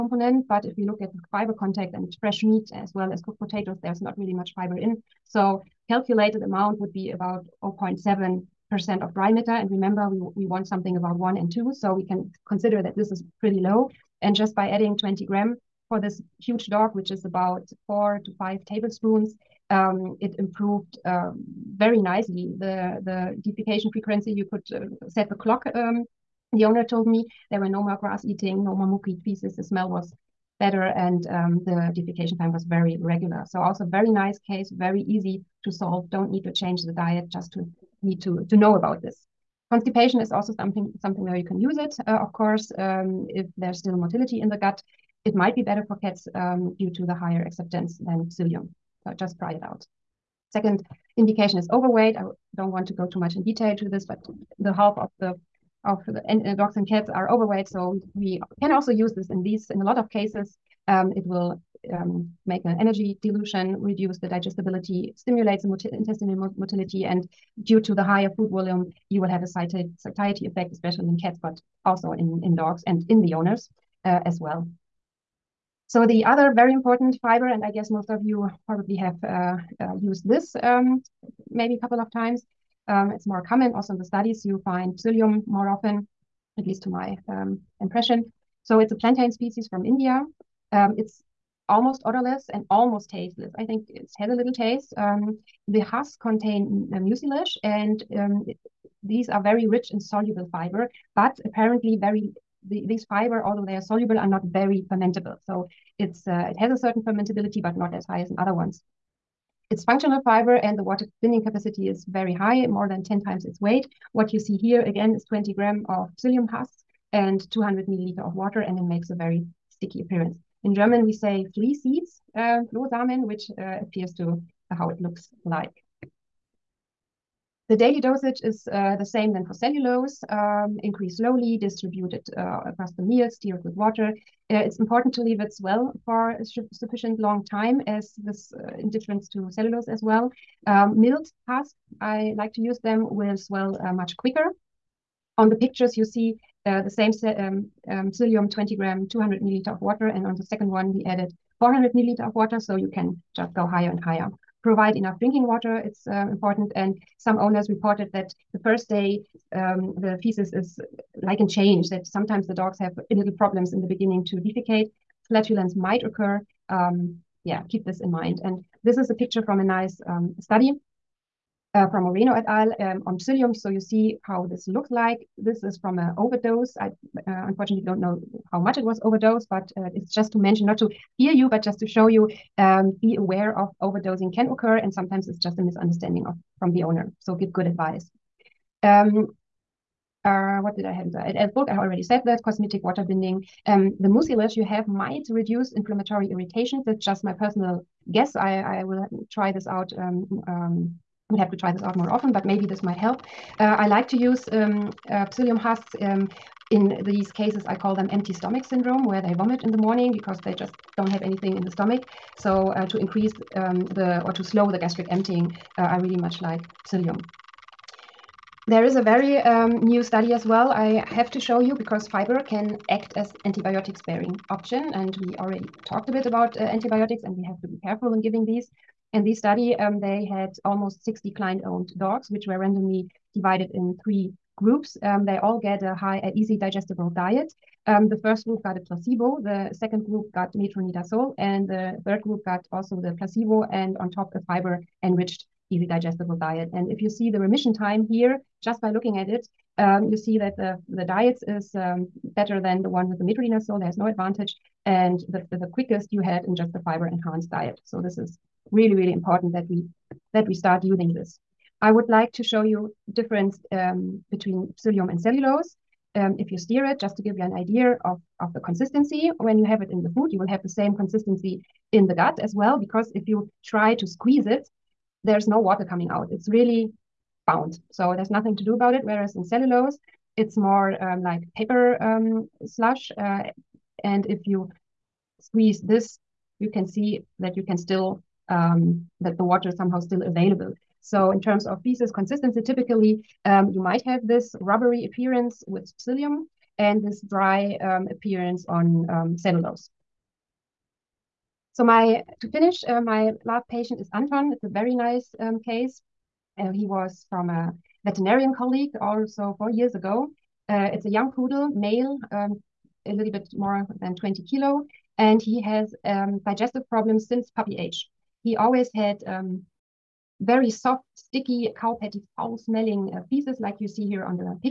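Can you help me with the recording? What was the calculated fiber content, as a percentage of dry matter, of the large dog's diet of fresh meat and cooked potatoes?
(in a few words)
0.7 percent.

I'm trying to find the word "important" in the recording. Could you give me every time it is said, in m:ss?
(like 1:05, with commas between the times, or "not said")
1:16, 2:14, 2:36, 4:19.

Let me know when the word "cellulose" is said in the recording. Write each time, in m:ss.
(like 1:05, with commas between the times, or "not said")
2:09, 2:19, 4:25, 4:39, 4:59.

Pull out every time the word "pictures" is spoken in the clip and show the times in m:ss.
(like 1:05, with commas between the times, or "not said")
2:25, 2:49.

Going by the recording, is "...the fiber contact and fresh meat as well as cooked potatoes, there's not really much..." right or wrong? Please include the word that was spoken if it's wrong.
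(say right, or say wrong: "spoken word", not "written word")
right.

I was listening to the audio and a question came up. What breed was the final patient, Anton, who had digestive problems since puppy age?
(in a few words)
poodle.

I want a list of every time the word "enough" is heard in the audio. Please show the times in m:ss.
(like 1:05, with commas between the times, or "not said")
2:34.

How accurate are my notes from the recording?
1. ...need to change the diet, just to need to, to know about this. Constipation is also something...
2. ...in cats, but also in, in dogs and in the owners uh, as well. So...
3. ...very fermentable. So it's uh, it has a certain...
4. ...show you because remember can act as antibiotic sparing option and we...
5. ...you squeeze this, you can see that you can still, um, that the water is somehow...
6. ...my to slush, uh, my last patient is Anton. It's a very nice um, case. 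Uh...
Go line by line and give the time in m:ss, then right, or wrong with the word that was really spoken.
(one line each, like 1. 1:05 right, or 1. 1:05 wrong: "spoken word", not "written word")
1. 0:36 right
2. 1:11 right
3. 1:44 right
4. 3:41 wrong: "fiber", not "remember"
5. 4:44 right
6. 5:01 wrong: "finish", not "slush".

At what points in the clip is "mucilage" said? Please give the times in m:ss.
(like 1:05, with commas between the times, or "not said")
1:37, 3:14.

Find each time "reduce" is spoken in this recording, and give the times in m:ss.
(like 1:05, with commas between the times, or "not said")
1:03, 3:15.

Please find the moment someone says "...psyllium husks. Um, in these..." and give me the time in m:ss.
3:25.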